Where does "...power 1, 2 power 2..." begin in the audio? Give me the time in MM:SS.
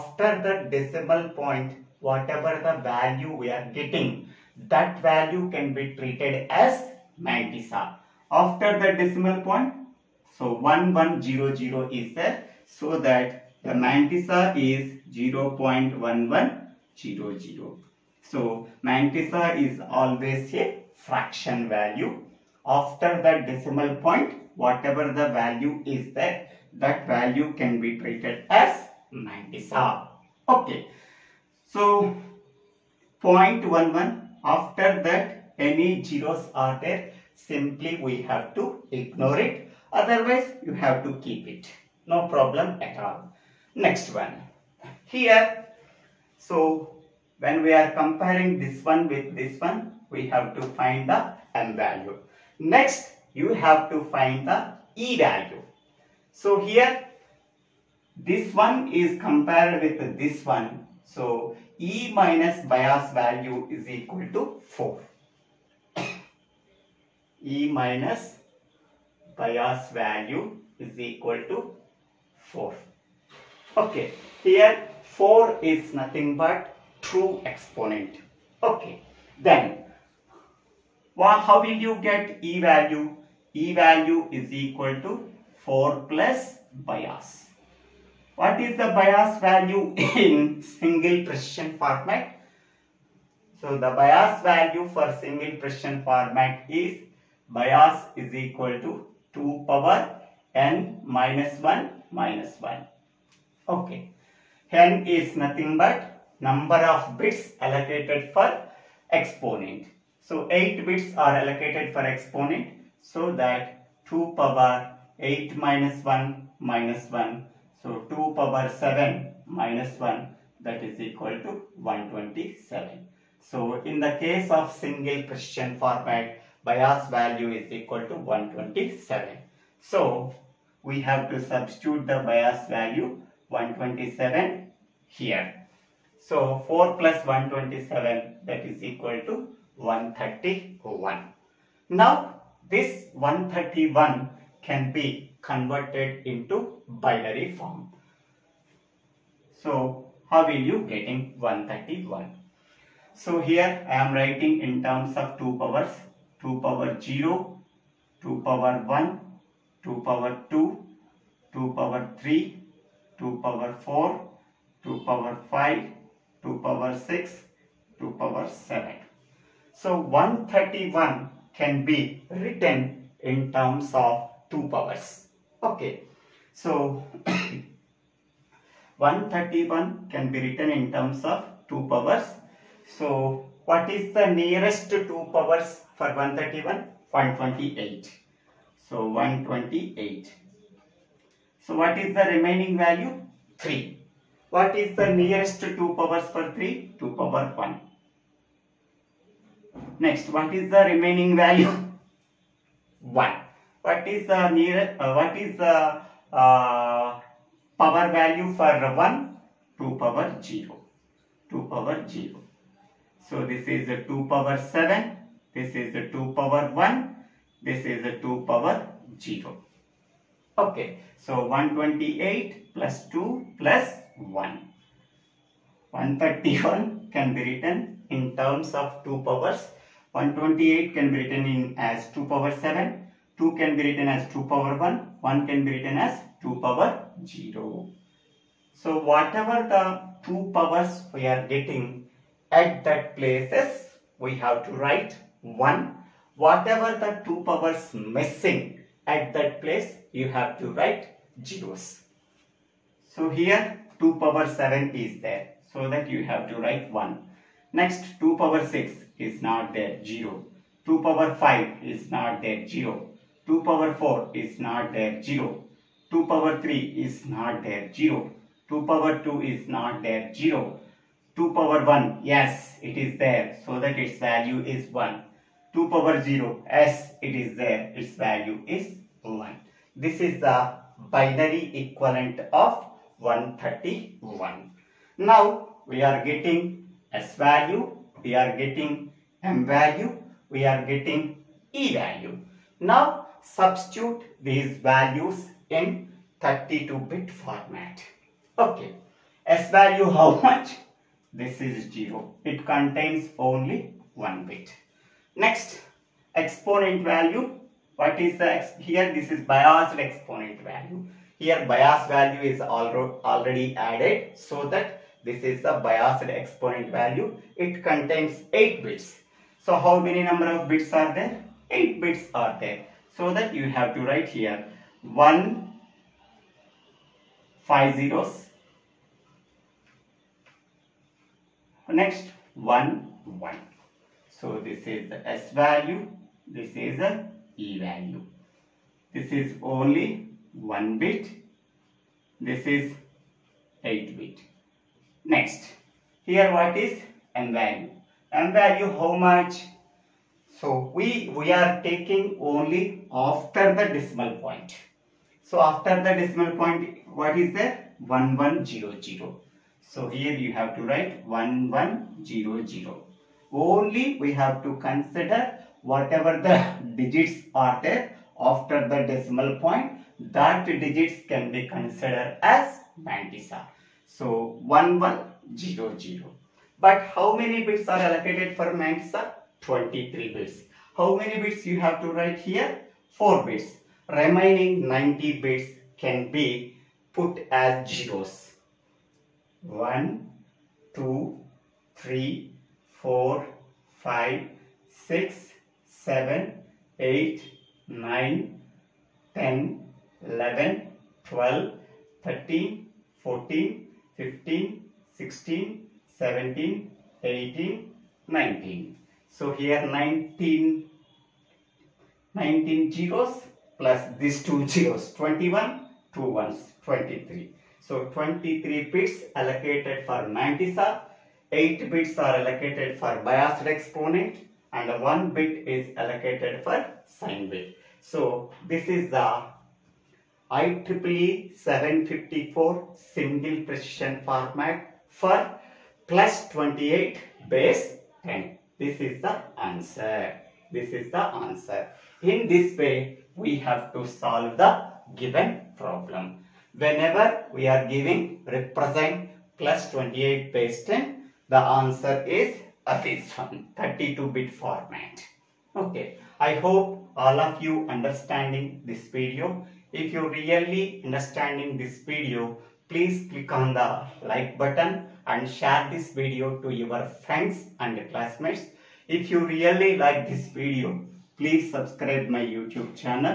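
02:38.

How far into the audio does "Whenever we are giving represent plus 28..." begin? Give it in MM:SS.
07:26.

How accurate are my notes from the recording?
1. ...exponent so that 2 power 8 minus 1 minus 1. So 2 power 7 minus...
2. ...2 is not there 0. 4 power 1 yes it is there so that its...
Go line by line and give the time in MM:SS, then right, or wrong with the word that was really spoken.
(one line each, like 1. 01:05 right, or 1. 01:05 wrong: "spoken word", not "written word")
1. 01:52 right
2. 04:29 wrong: "2", not "4".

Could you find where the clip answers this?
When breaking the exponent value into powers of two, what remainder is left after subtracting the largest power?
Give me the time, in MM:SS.
03:11.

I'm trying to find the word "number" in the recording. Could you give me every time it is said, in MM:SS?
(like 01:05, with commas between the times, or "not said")
01:46, 05:20.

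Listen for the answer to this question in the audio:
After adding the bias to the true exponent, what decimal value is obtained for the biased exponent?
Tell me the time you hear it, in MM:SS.
02:16.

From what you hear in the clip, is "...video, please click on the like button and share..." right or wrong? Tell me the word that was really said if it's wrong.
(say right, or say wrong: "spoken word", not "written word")
right.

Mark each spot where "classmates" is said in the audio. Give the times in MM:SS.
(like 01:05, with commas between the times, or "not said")
07:48.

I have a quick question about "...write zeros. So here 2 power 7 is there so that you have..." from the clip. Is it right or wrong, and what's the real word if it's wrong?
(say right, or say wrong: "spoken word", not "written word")
right.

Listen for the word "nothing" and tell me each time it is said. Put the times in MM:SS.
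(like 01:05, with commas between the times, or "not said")
01:15, 01:45.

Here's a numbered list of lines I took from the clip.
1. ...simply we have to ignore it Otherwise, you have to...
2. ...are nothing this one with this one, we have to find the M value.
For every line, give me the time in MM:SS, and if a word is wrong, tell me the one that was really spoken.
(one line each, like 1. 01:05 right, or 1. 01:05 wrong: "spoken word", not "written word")
1. 00:37 right
2. 00:47 wrong: "comparing", not "nothing".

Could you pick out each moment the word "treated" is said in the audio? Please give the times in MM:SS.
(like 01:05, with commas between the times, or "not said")
00:05, 00:28.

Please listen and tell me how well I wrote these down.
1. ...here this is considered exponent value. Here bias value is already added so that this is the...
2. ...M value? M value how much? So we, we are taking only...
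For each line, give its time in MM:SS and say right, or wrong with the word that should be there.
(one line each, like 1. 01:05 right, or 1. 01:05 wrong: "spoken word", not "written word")
1. 05:08 wrong: "biased", not "considered"
2. 05:47 right.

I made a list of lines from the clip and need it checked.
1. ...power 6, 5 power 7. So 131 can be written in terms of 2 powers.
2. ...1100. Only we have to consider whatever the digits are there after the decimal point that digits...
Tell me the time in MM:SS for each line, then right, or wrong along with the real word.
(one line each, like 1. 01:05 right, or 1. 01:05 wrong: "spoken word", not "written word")
1. 02:46 wrong: "2", not "5"
2. 06:01 right.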